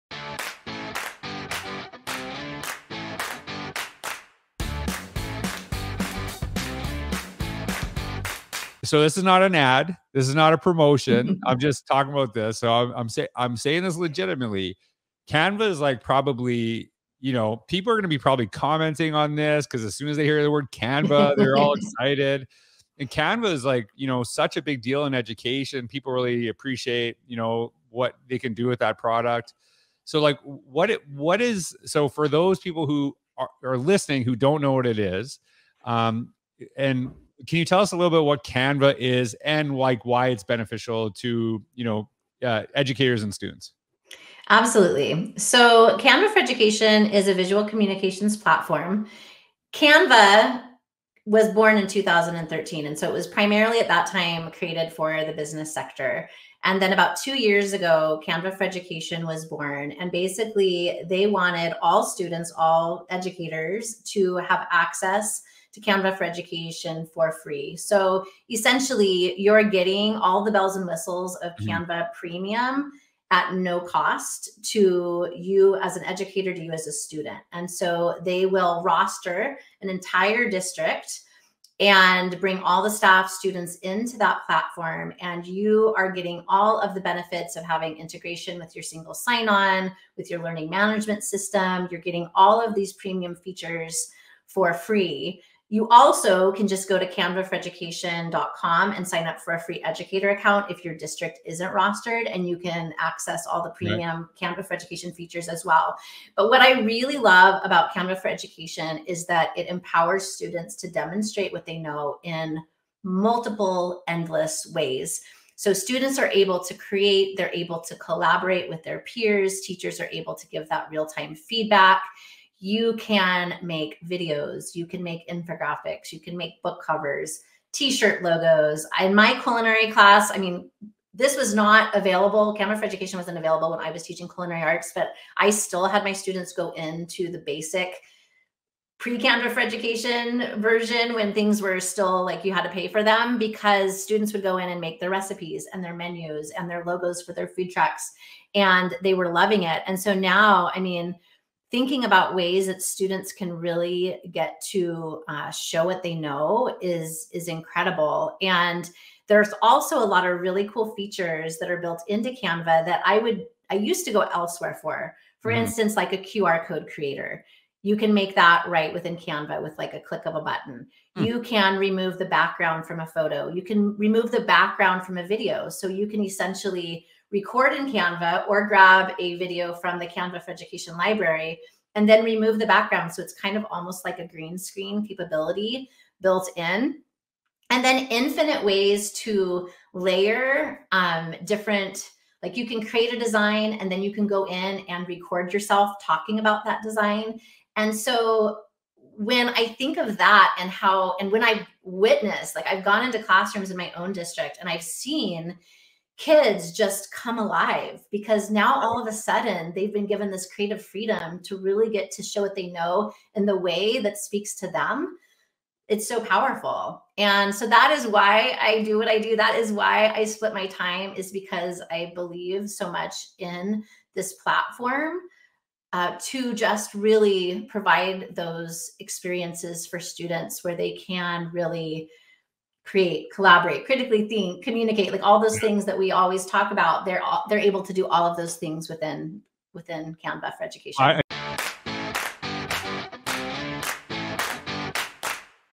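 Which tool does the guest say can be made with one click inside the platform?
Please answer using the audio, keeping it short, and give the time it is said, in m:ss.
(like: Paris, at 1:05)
QR code creator, at 2:46.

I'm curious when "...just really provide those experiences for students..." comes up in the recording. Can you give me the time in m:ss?
3:46.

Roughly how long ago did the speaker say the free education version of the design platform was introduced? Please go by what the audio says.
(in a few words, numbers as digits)
about two years ago.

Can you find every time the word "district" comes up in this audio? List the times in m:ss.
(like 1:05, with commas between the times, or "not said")
1:20, 1:40, 3:24.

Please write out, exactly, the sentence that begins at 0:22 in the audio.
And Canva is like you know such a big deal in education.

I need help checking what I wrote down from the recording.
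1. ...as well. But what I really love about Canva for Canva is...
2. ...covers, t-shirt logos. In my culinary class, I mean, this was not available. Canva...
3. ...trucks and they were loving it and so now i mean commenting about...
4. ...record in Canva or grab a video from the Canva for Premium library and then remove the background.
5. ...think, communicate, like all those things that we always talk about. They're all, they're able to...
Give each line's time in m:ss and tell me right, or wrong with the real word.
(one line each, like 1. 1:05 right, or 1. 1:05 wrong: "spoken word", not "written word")
1. 1:45 wrong: "Education", not "Canva"
2. 2:06 right
3. 2:27 wrong: "thinking", not "commenting"
4. 2:57 wrong: "Education", not "Premium"
5. 3:54 right.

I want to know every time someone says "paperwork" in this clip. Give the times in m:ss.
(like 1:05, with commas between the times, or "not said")
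not said.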